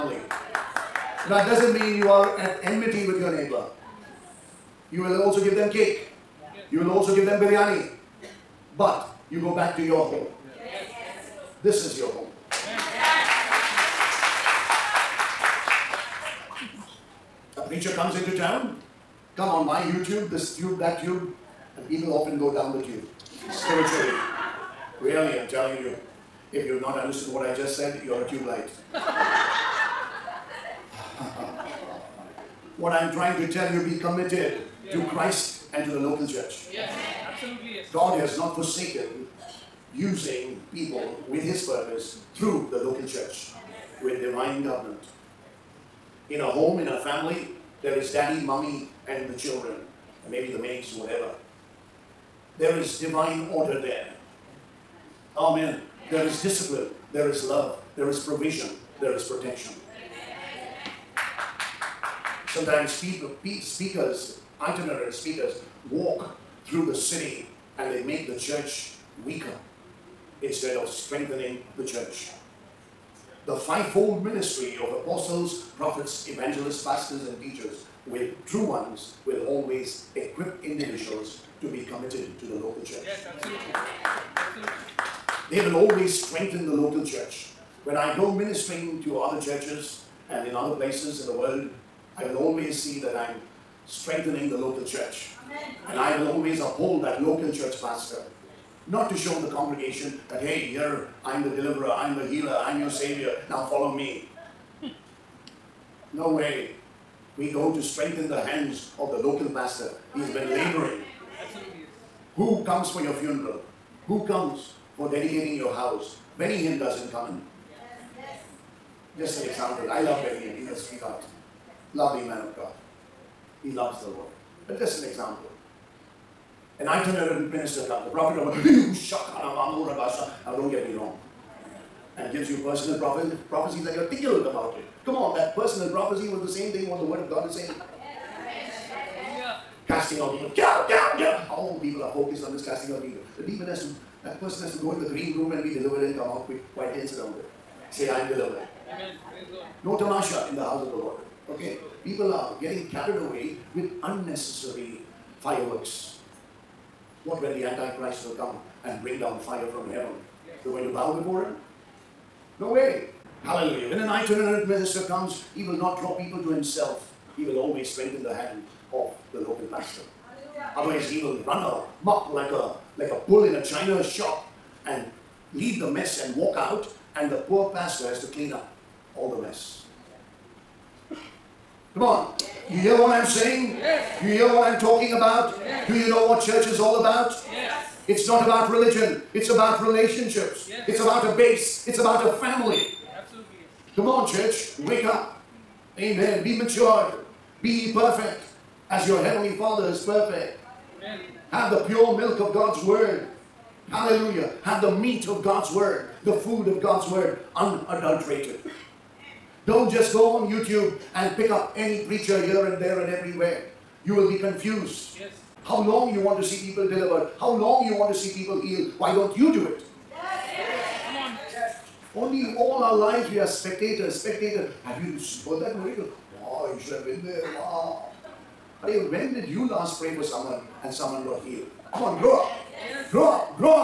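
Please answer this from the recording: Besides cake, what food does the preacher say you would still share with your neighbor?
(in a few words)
Biryani.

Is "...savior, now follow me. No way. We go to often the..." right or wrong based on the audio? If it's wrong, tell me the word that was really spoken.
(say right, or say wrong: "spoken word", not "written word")
wrong: "strengthen", not "often".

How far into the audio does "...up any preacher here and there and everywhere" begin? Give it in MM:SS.
03:31.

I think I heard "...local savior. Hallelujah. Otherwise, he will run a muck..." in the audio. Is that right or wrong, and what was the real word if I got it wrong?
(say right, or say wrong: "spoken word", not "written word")
wrong: "pastor", not "savior".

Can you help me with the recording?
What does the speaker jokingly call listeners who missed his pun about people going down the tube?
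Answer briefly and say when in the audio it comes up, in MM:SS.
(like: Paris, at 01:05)
Tube light, at 00:28.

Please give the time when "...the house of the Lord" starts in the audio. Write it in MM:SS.
02:30.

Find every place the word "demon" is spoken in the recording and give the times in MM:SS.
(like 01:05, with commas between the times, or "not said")
02:23.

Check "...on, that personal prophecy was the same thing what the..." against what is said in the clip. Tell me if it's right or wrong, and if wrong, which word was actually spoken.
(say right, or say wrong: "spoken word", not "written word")
right.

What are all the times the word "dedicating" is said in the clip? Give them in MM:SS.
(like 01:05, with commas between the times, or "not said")
01:55.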